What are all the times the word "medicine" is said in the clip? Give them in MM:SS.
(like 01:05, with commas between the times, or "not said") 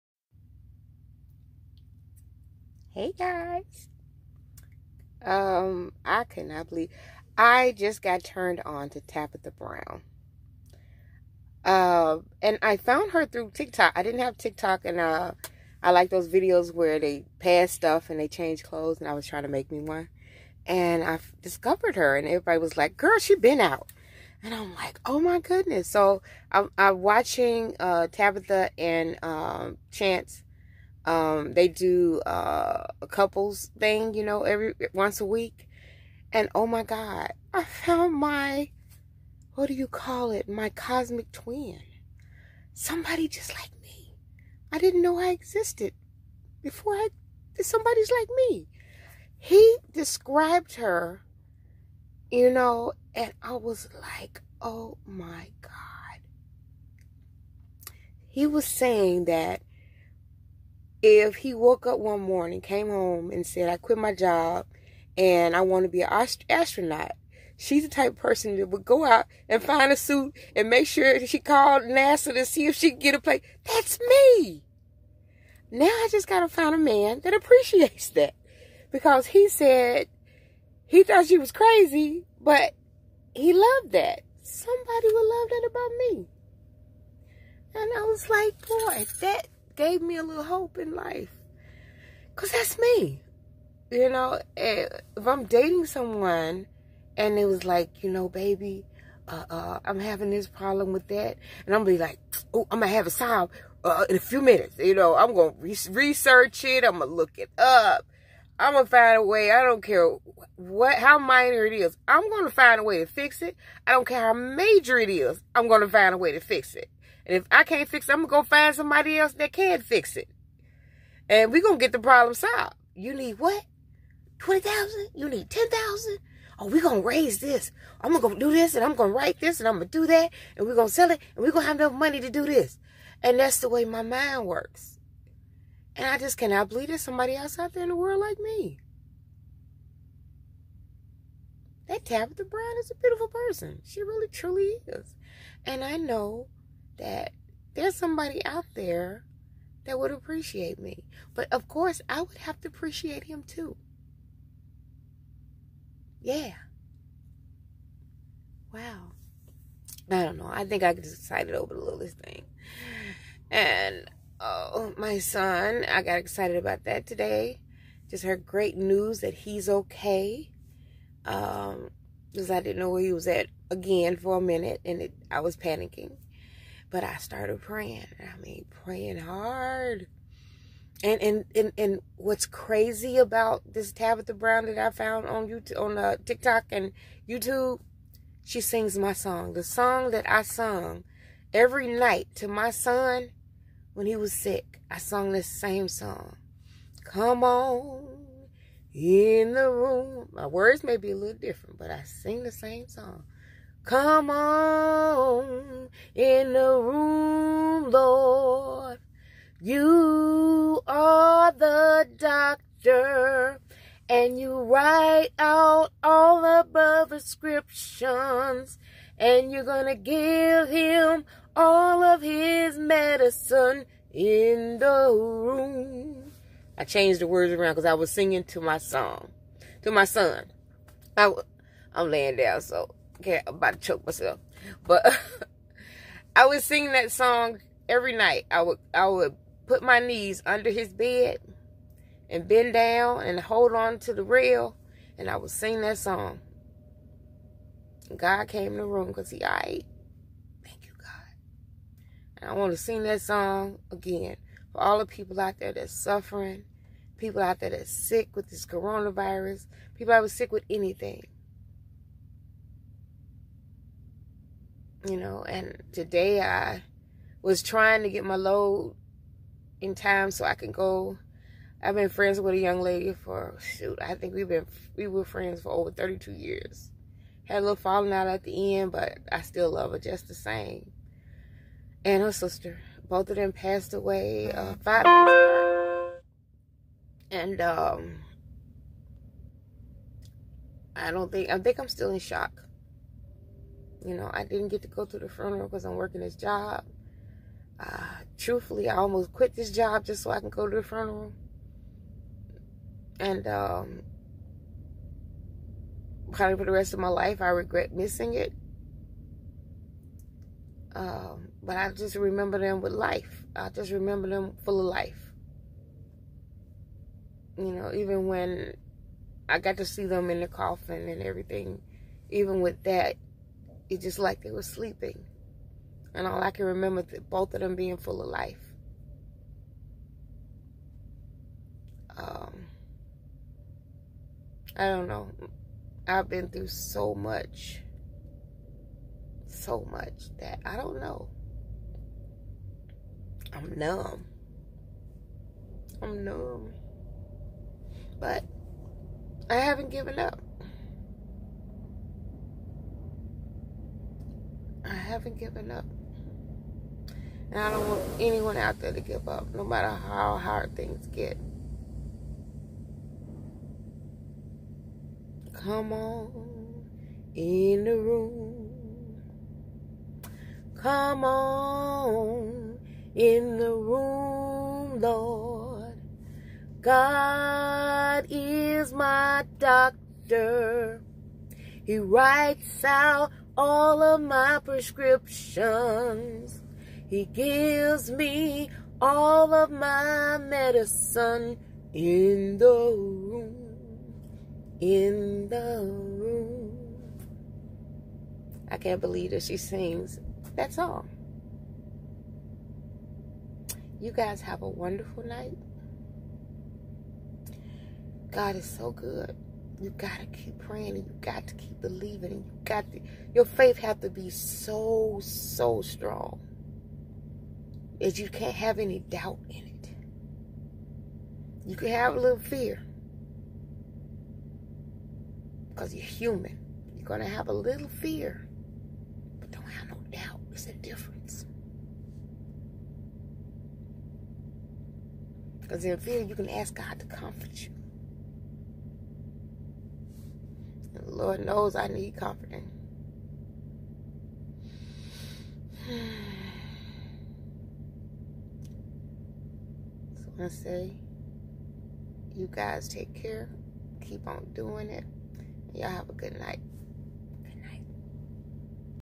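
03:42, 06:30.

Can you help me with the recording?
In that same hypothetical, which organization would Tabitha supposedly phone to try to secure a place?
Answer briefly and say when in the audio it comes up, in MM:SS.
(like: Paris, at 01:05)
NASA, at 01:11.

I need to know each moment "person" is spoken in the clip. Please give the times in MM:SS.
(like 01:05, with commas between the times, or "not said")
01:08, 02:23.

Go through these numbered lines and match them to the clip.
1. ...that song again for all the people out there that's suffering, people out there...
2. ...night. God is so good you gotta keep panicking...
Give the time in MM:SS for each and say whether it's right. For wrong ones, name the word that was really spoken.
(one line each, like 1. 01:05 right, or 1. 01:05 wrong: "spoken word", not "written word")
1. 04:13 right
2. 06:45 wrong: "praying", not "panicking".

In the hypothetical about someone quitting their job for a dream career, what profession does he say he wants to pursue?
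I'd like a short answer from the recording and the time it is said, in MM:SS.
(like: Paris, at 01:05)
Astronaut, at 01:06.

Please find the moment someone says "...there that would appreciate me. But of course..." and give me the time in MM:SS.
02:28.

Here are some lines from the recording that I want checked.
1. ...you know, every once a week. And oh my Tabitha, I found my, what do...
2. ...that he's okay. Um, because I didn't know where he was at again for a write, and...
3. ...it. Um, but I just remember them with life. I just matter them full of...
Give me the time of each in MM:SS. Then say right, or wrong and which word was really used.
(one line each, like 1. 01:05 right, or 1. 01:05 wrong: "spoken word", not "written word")
1. 00:34 wrong: "God", not "Tabitha"
2. 02:49 wrong: "minute", not "write"
3. 05:08 wrong: "remember", not "matter".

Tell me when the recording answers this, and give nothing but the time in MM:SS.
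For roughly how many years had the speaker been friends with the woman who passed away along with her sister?
04:35.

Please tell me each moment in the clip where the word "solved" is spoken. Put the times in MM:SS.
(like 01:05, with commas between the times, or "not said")
01:43, 02:02.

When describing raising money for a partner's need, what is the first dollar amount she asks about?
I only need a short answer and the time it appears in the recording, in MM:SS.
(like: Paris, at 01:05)
20,000, at 02:04.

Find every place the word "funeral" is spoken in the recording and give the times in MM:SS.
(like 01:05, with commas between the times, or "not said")
04:55, 05:00.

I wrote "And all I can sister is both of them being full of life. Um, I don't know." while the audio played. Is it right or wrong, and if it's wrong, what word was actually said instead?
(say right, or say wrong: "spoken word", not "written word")
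wrong: "remember", not "sister".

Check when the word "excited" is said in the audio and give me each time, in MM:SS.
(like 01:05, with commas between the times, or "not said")
02:41, 02:46.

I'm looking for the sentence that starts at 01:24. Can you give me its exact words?
Somebody would love that about me.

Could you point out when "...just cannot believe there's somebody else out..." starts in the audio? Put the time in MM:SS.
02:16.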